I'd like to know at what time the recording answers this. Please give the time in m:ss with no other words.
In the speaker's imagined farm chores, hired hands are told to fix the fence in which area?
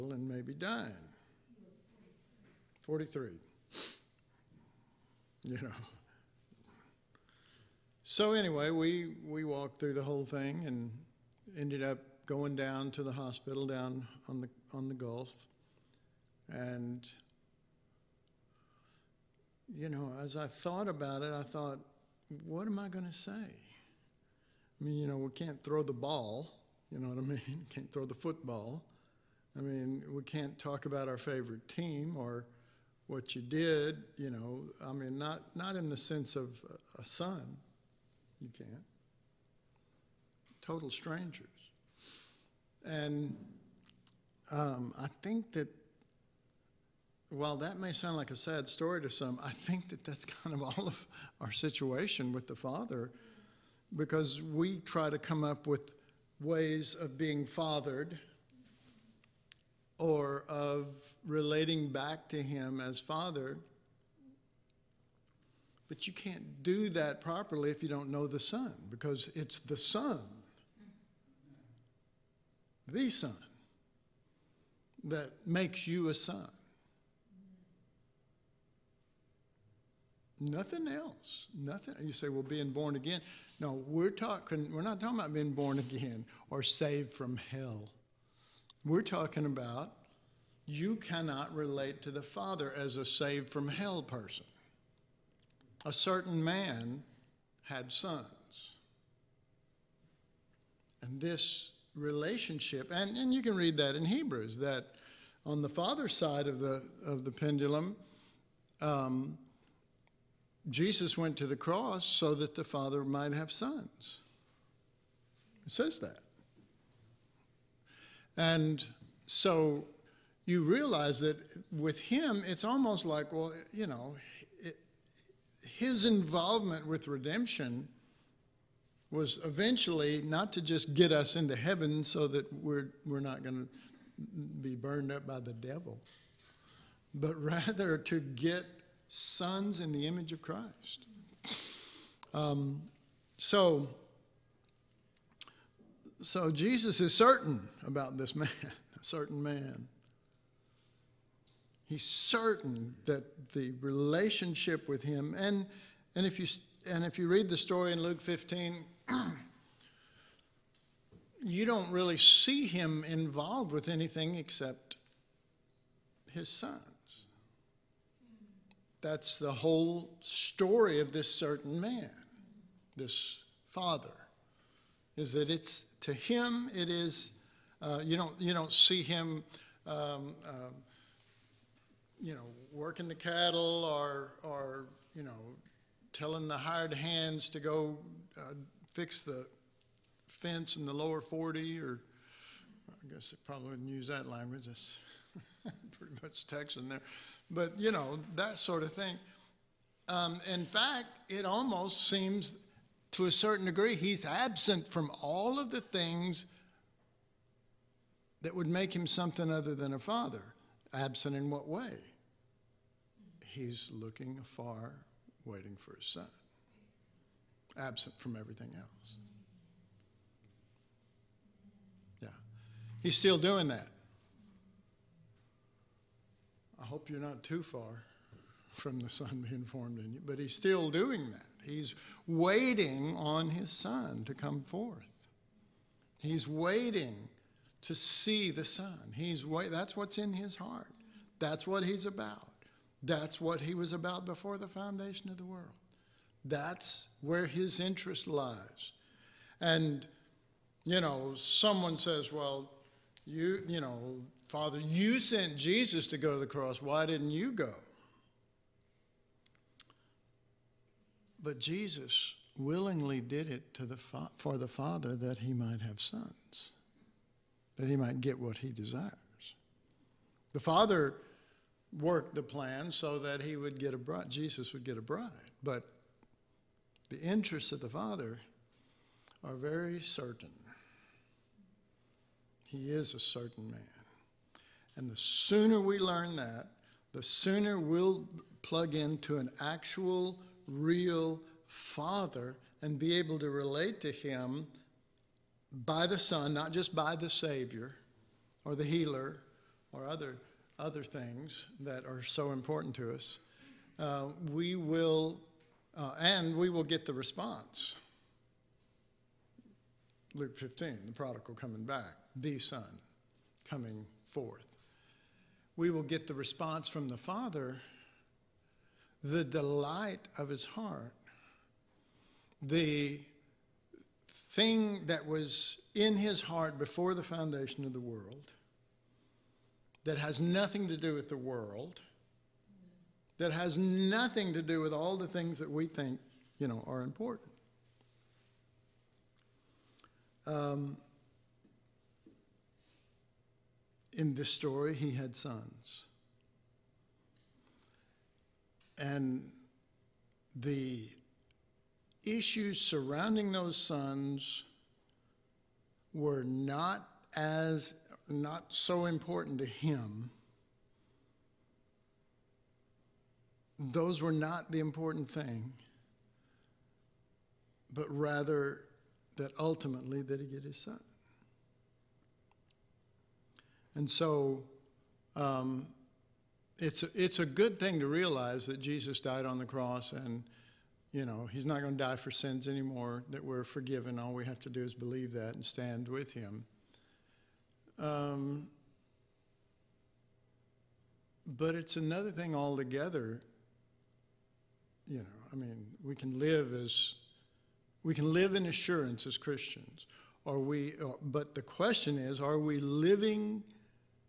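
3:10.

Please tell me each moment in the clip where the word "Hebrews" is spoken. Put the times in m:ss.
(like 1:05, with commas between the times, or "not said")
1:44.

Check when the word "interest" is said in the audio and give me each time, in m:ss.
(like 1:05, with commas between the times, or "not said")
4:07, 4:37.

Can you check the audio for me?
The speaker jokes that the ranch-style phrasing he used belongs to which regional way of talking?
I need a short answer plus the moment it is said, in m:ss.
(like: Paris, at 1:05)
Texan, at 3:16.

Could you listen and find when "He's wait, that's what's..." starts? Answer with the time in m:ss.
3:59.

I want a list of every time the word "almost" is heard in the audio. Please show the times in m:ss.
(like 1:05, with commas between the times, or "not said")
2:02, 3:21.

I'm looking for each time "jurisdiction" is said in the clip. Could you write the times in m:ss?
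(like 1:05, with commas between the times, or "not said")
not said.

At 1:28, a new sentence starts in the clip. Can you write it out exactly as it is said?
We're talking about you cannot relate to the Father as a saved from hell person.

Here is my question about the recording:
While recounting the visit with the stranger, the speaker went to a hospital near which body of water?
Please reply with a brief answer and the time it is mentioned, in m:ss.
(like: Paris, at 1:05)
the Gulf, at 0:14.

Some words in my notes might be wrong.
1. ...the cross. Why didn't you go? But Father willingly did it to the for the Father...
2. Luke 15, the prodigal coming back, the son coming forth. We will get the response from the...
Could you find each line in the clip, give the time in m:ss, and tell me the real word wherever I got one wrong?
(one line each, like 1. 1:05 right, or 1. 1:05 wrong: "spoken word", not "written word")
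1. 4:16 wrong: "Jesus", not "Father"
2. 5:10 right.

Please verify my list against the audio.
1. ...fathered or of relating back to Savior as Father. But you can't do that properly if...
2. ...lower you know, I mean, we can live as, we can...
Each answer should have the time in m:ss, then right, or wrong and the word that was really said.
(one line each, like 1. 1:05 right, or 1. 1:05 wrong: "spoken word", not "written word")
1. 0:57 wrong: "Him", not "Savior"
2. 6:32 wrong: "altogether", not "lower".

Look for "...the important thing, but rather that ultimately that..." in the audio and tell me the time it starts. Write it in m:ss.
6:04.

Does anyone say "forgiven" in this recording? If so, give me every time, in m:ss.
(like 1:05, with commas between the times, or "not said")
6:23.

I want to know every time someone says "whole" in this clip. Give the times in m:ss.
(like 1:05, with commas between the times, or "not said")
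0:10, 2:49.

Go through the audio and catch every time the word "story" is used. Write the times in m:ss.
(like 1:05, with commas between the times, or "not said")
0:48, 2:37, 2:50, 5:44.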